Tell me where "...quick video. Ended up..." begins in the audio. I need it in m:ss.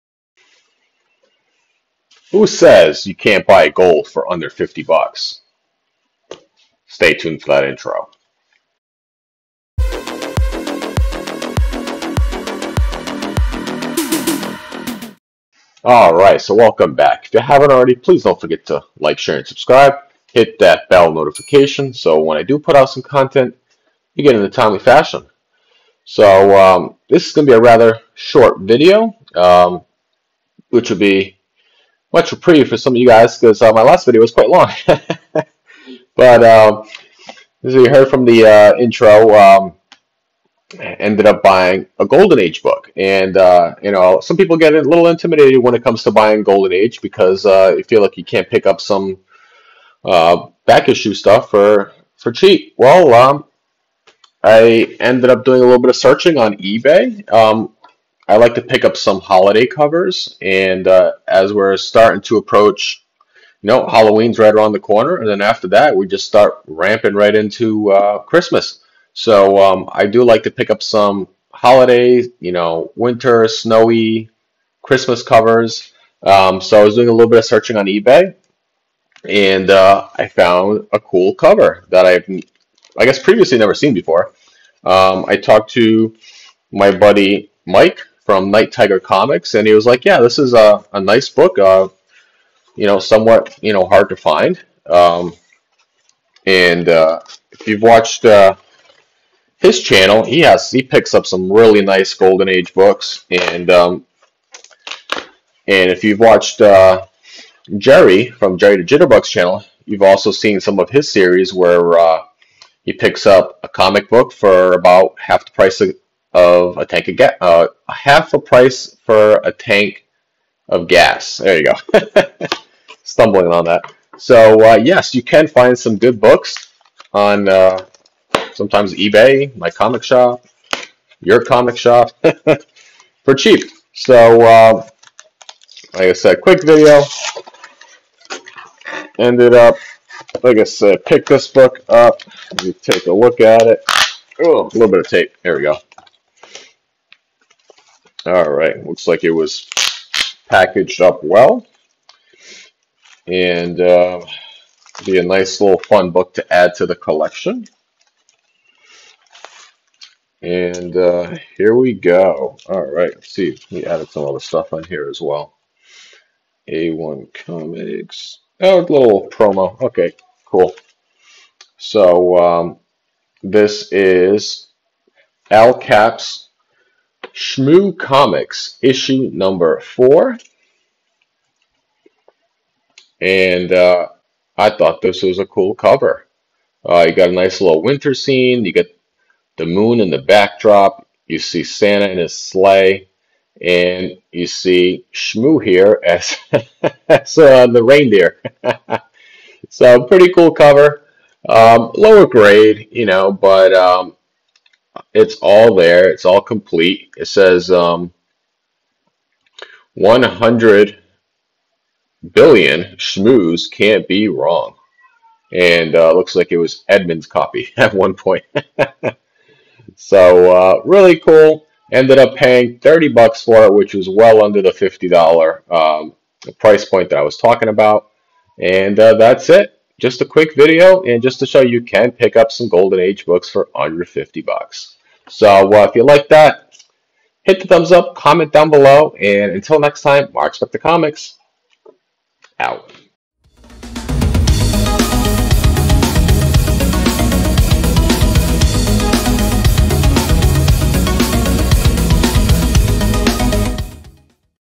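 2:16.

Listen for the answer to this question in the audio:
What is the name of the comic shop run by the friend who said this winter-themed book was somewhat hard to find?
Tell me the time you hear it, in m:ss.
1:28.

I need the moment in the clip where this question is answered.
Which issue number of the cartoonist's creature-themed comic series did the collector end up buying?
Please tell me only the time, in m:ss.
2:59.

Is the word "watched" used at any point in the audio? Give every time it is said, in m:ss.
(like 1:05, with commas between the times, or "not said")
1:37, 1:46.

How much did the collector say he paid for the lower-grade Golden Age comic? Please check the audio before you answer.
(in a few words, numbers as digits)
$30.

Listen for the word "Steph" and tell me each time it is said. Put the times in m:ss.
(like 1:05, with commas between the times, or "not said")
not said.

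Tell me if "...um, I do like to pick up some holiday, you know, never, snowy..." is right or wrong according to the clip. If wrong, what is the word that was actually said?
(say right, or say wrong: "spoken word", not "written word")
wrong: "winter", not "never".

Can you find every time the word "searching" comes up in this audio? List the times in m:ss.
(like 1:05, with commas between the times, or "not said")
0:55, 1:17.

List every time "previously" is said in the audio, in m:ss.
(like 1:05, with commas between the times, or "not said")
1:23.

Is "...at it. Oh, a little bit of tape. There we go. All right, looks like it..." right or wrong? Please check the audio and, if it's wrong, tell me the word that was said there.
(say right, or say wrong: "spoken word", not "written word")
right.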